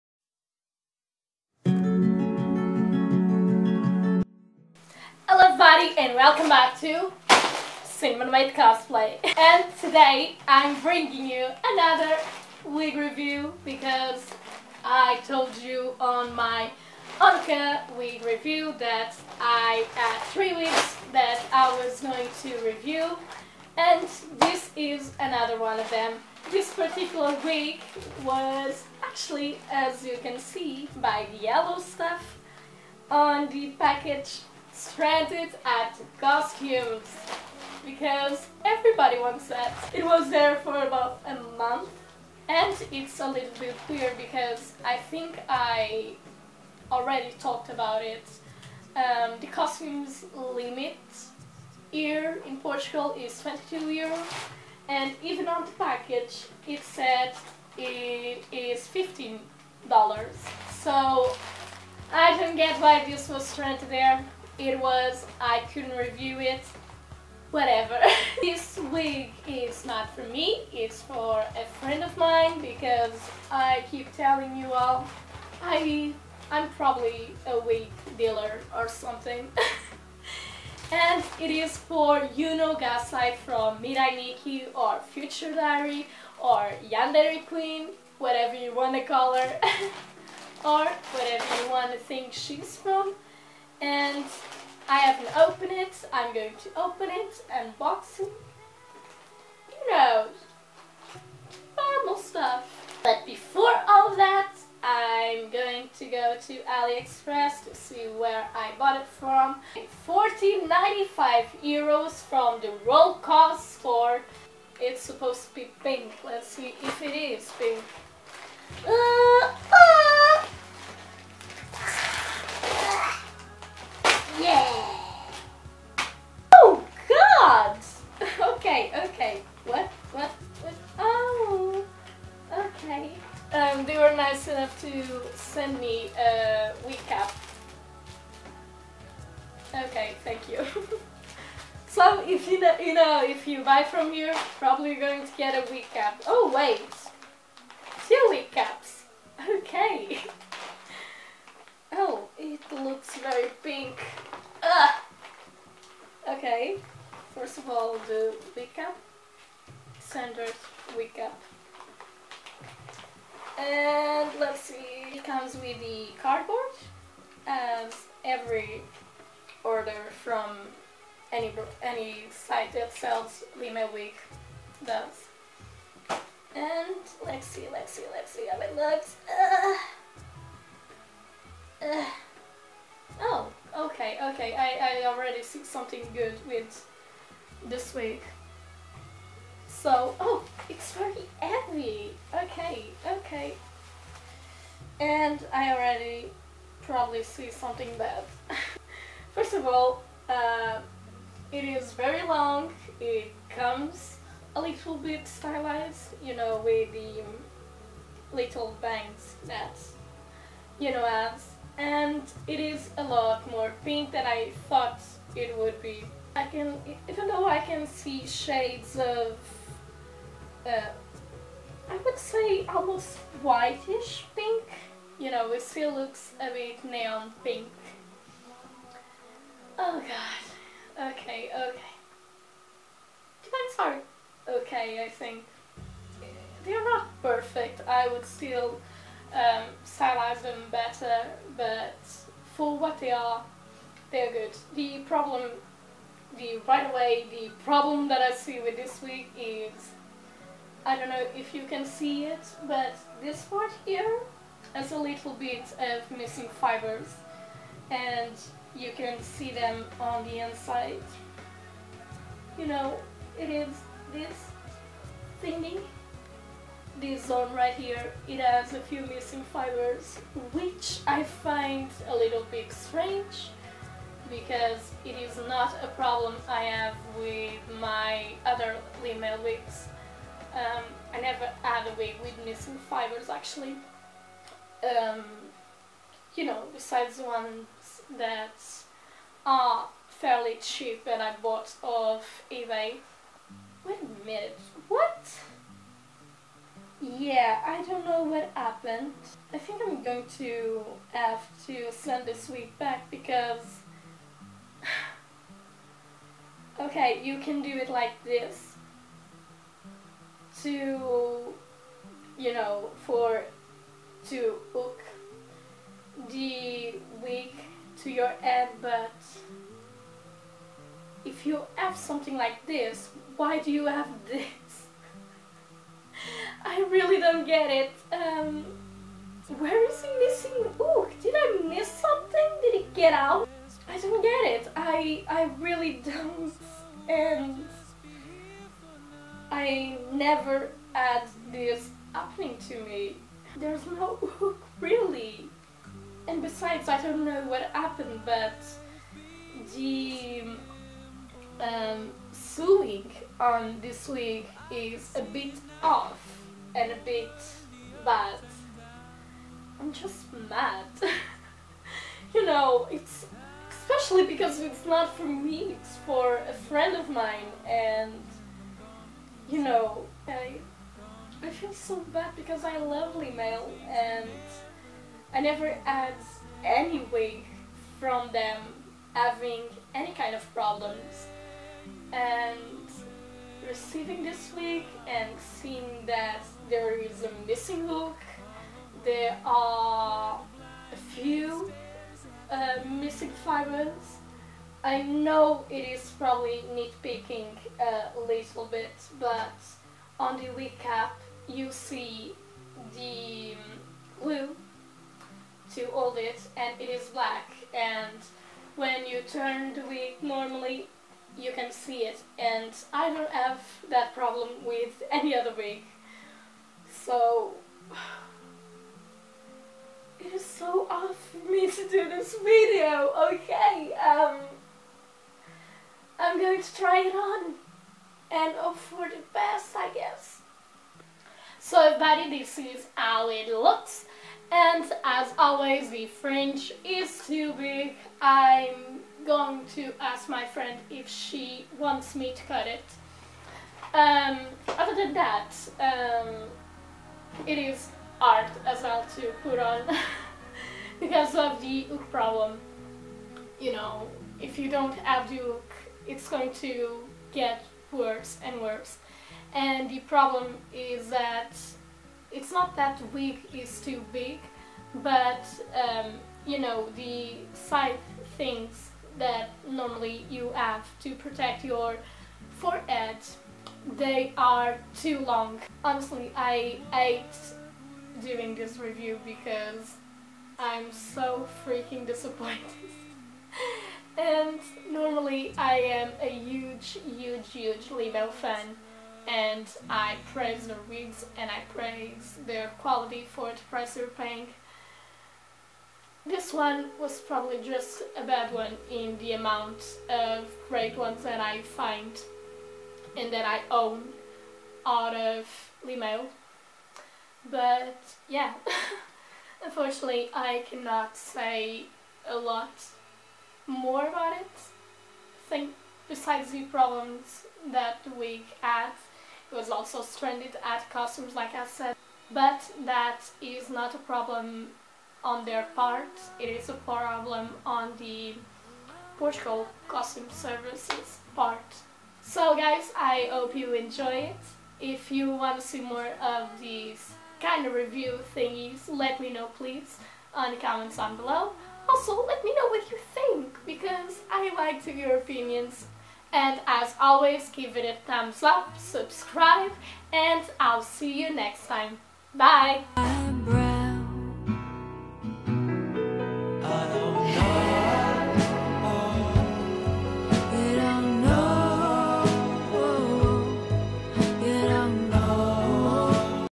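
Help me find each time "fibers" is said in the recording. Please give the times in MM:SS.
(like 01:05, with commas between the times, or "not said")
04:16, 04:29, 04:42, 06:33.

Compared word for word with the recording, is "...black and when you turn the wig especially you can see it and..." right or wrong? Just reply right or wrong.
wrong.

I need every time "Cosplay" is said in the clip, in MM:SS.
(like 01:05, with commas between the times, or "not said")
00:08.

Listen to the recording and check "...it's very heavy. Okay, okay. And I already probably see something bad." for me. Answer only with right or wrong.
right.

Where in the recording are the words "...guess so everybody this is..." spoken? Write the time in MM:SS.
07:09.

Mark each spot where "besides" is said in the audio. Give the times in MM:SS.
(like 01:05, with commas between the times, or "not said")
04:46, 05:46, 08:36.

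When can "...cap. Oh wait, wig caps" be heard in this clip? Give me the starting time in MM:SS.
02:25.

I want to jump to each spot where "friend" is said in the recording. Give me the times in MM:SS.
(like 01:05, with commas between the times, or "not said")
01:11, 06:06, 07:20.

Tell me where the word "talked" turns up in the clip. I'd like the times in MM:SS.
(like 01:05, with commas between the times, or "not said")
00:47.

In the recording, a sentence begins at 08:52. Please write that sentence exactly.
So guys, I hope you enjoy it.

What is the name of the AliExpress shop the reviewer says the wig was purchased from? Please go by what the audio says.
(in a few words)
Roll Cost.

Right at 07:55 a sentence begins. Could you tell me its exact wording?
Honestly, I hate doing this review because I'm so freaking disappointed.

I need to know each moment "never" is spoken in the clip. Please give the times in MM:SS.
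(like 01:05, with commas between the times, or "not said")
04:41, 05:40, 06:15.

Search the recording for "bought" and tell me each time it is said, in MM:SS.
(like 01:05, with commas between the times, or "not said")
01:48, 04:51.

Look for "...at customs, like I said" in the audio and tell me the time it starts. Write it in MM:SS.
08:40.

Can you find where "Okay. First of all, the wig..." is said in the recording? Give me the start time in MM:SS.
02:36.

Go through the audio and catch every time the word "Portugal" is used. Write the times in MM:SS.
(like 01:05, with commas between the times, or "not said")
00:52, 08:49.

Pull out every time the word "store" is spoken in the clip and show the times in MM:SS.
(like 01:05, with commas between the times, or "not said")
01:53.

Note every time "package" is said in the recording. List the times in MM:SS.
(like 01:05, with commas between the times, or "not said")
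00:33, 00:55.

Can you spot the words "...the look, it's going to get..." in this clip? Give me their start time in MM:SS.
07:35.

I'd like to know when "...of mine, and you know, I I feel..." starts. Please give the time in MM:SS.
06:06.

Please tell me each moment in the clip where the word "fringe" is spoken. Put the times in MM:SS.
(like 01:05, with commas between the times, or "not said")
07:16.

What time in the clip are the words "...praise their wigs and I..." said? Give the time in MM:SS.
08:10.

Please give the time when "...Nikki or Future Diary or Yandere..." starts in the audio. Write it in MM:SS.
01:24.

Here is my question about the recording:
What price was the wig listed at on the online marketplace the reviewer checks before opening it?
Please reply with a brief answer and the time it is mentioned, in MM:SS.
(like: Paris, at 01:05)
14.95 euros, at 01:50.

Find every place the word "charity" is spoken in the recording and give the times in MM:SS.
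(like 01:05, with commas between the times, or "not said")
not said.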